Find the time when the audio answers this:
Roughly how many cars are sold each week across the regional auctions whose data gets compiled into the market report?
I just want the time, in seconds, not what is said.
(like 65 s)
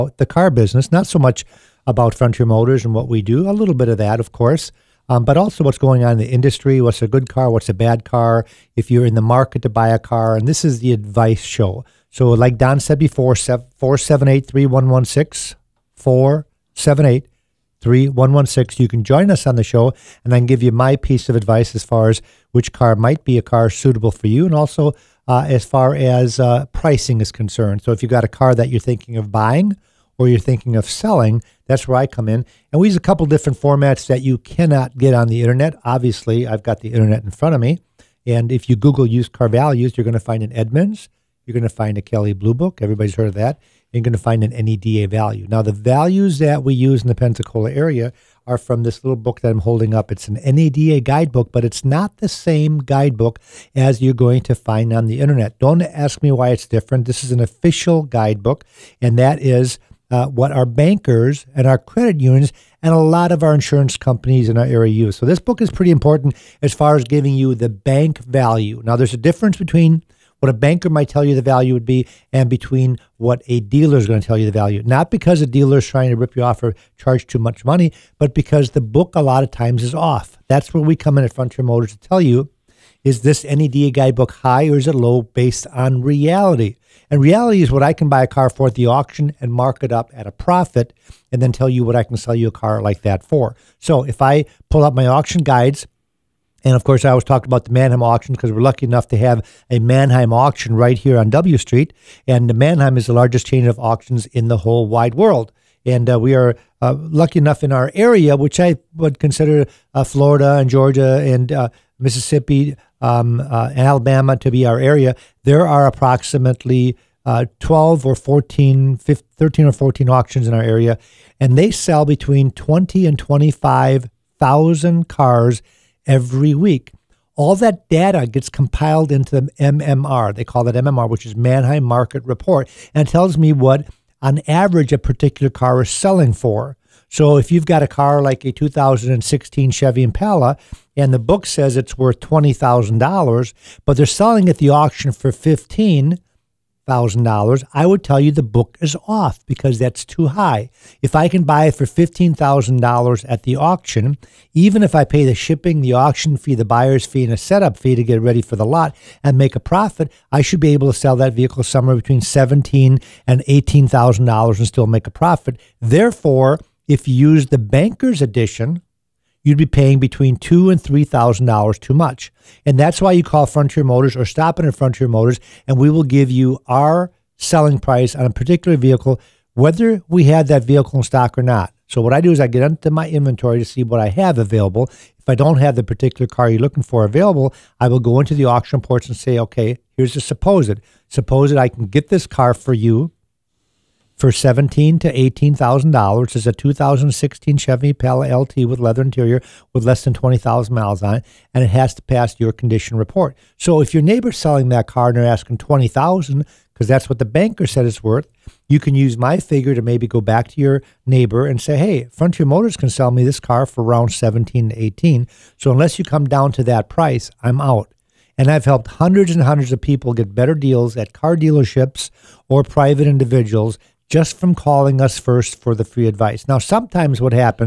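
122 s.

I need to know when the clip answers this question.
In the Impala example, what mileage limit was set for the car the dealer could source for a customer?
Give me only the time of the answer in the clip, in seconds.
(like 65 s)
199 s.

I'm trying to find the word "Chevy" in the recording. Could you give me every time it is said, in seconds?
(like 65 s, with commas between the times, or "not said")
139 s, 197 s.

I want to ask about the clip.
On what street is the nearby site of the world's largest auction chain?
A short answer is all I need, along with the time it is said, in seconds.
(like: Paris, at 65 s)
W Street, at 101 s.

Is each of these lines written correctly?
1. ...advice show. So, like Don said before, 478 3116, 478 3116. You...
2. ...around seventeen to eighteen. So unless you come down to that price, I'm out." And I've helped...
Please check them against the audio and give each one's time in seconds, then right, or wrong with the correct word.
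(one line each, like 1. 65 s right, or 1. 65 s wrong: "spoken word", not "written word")
1. 10 s right
2. 213 s right.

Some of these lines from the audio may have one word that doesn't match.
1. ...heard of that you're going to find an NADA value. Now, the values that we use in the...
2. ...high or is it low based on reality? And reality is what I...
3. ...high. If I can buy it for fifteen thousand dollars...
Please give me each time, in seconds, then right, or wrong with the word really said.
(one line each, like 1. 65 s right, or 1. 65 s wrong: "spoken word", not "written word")
1. 43 s right
2. 84 s right
3. 150 s right.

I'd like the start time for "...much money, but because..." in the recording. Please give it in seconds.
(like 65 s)
77 s.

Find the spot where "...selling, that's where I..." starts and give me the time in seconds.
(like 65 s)
30 s.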